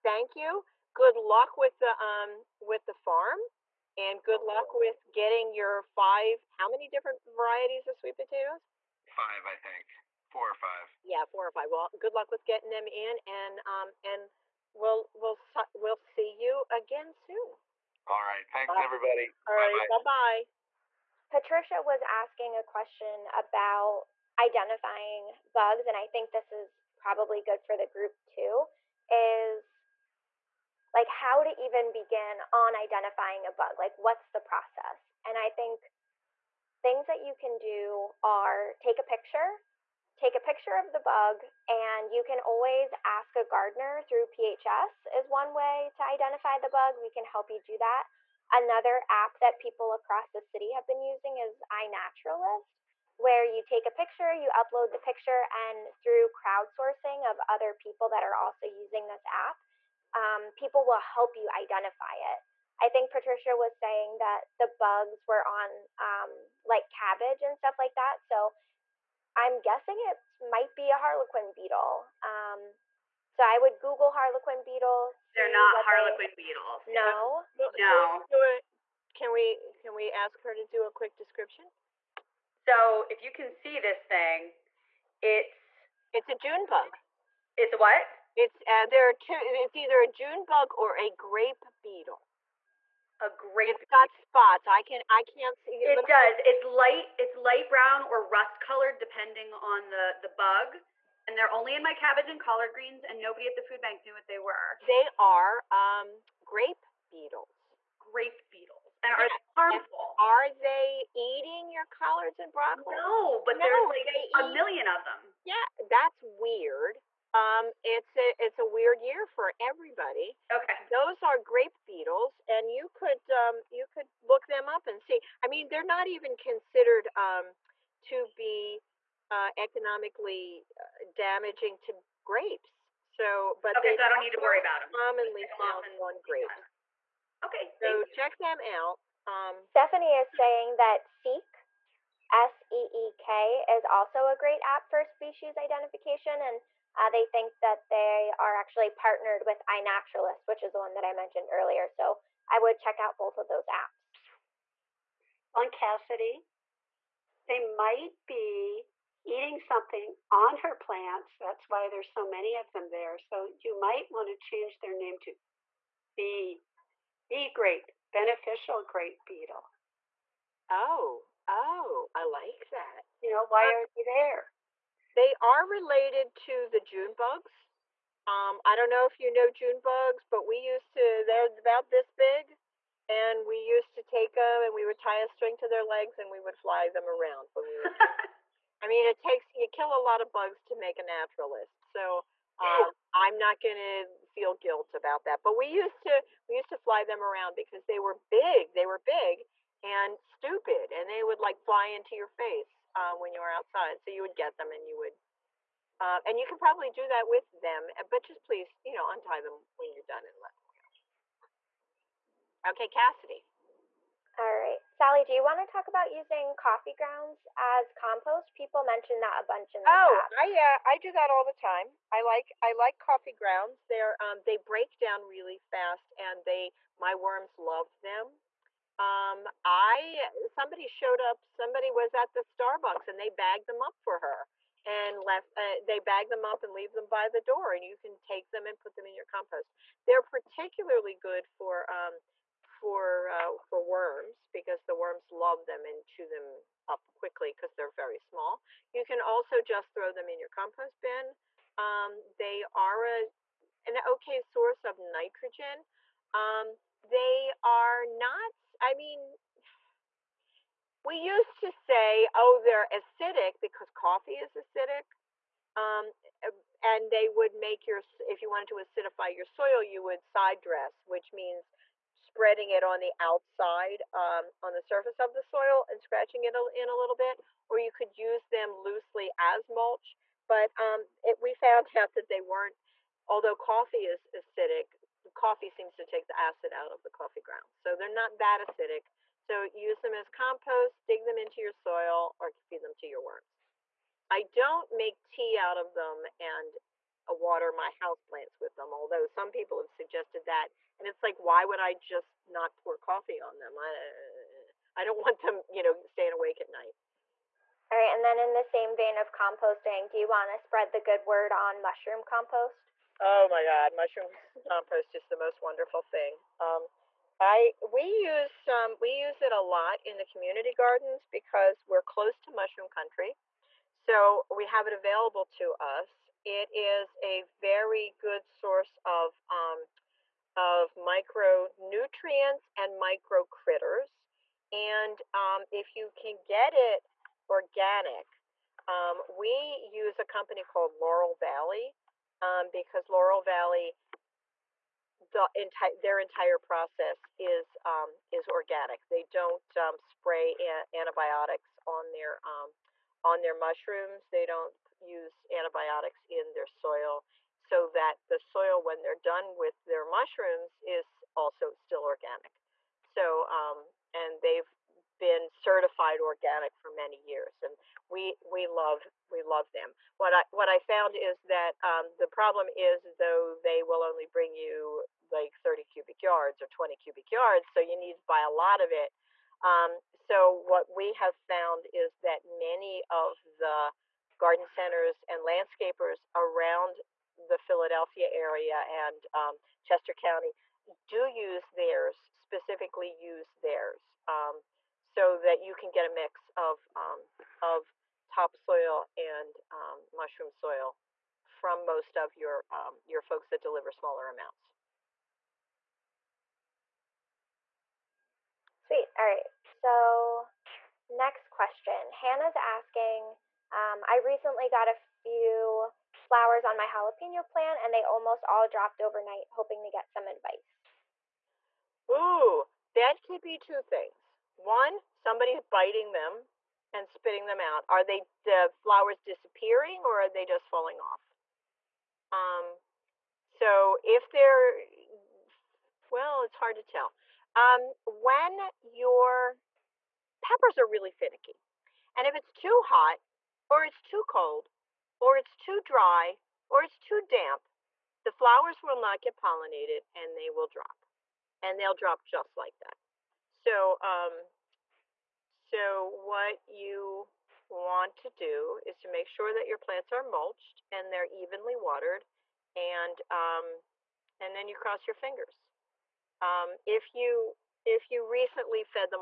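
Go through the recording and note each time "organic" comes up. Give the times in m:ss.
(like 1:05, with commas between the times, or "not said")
5:37, 5:48, 6:02, 6:06.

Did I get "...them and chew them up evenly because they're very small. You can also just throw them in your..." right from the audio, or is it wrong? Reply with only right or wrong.
wrong.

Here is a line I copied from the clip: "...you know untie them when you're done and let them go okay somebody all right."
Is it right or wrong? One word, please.
wrong.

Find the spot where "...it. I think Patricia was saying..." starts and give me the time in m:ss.
1:02.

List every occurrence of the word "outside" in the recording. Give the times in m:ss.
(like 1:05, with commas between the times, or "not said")
3:23, 4:33.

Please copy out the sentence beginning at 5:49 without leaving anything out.
They don't um, spray antibiotics on their on their mushrooms.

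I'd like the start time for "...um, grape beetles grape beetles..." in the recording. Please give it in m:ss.
1:45.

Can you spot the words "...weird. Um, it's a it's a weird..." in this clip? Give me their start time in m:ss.
1:56.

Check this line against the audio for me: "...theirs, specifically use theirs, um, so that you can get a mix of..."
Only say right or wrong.
right.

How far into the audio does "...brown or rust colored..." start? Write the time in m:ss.
1:37.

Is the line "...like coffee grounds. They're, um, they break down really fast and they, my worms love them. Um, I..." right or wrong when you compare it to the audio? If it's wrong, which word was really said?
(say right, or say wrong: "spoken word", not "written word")
right.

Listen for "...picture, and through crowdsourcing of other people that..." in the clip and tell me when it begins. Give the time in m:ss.
0:54.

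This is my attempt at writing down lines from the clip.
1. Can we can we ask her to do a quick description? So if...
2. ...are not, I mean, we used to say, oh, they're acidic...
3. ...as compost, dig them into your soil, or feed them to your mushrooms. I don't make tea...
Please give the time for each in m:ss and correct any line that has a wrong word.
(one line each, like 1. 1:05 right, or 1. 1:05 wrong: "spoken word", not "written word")
1. 1:19 right
2. 4:17 right
3. 4:50 wrong: "worms", not "mushrooms".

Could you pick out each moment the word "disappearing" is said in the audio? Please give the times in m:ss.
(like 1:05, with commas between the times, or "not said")
7:09.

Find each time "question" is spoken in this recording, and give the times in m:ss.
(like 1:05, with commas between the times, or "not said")
0:22, 6:51.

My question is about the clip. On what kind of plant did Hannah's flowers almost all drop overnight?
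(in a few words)
jalapeno.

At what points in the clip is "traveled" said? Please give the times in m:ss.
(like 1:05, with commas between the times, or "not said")
not said.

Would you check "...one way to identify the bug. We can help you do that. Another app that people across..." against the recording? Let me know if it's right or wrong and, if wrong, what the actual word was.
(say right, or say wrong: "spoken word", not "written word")
right.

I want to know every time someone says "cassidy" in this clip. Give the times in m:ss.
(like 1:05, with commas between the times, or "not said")
2:35, 3:32.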